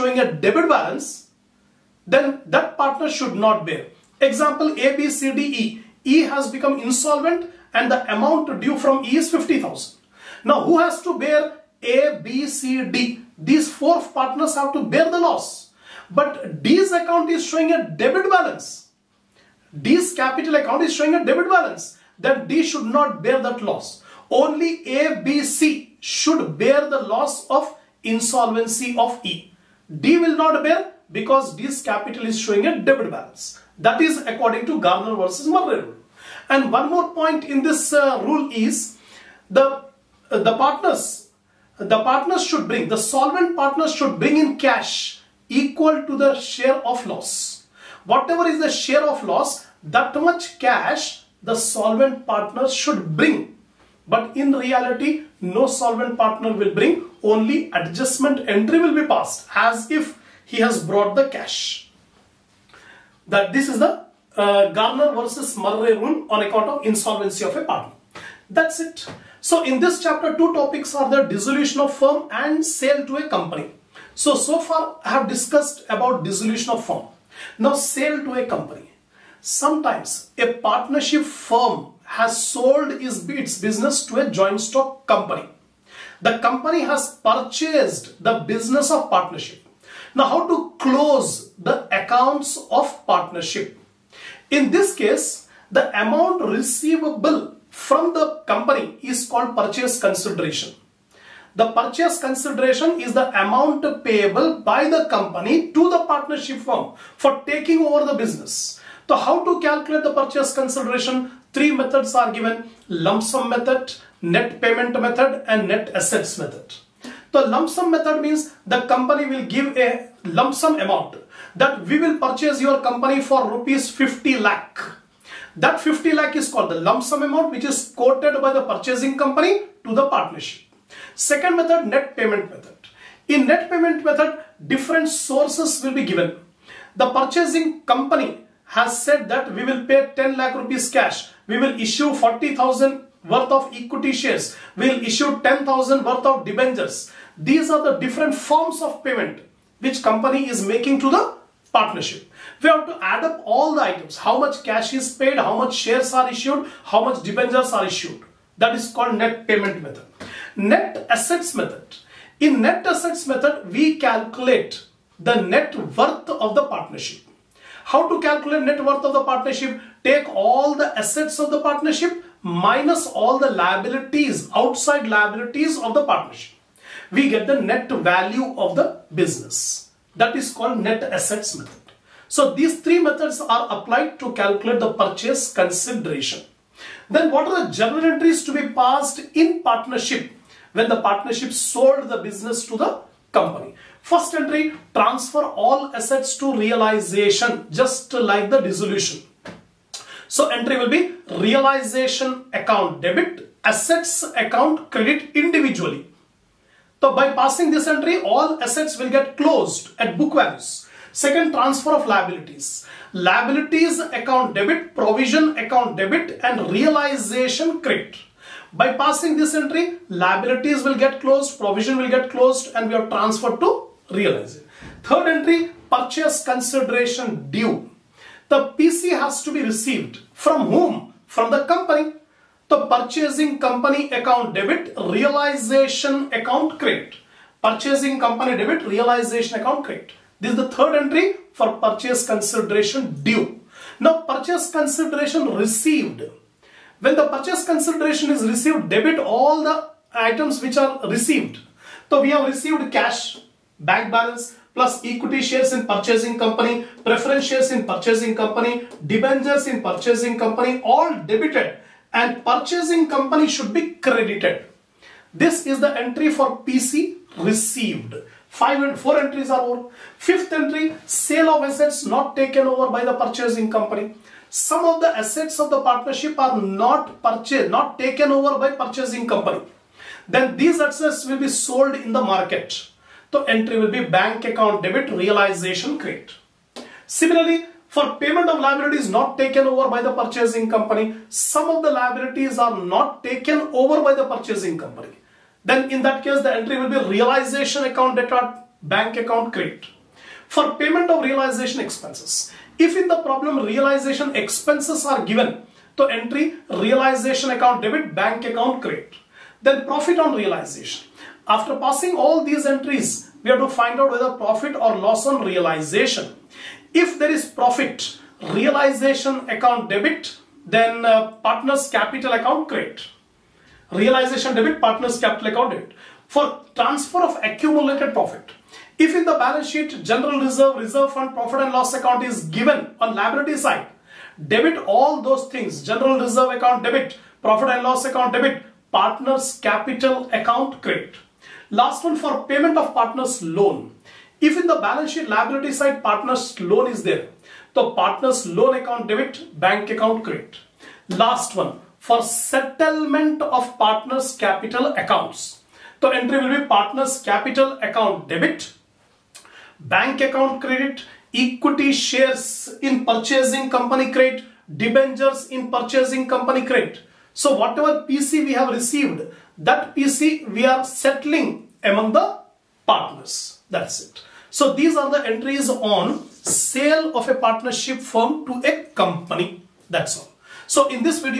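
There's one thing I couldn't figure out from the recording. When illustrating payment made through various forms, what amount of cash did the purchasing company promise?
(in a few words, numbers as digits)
10 lakh rupees.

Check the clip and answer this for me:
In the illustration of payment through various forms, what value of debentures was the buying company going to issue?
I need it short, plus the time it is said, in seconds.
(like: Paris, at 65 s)
10,000, at 145 s.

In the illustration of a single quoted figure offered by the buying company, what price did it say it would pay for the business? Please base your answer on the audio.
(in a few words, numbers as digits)
50 lakh.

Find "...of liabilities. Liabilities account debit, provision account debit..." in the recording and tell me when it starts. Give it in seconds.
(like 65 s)
211 s.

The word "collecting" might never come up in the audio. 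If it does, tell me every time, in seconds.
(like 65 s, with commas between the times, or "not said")
not said.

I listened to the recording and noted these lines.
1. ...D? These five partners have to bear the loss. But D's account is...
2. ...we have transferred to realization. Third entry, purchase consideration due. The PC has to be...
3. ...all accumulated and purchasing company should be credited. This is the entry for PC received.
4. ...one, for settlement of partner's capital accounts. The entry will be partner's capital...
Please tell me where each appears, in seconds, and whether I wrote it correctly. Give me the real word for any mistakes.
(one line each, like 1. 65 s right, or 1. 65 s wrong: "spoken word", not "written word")
1. 12 s wrong: "four", not "five"
2. 222 s right
3. 260 s wrong: "debited", not "accumulated"
4. 351 s right.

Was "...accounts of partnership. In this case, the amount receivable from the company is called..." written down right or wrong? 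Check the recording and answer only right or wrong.
right.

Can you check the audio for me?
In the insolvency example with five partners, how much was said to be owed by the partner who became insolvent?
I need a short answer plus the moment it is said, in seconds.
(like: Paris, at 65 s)
50,000, at 9 s.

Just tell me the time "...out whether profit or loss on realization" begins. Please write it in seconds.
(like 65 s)
313 s.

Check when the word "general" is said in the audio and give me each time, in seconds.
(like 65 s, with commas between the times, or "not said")
330 s, 335 s.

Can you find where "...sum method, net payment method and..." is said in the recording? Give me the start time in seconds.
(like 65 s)
113 s.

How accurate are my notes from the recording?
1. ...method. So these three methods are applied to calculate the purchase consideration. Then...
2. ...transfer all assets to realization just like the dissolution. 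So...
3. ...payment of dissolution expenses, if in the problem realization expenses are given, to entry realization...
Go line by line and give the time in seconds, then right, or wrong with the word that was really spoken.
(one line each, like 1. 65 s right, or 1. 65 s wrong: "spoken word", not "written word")
1. 181 s right
2. 194 s right
3. 300 s wrong: "realization", not "dissolution".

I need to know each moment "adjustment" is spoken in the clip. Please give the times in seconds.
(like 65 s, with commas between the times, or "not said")
57 s.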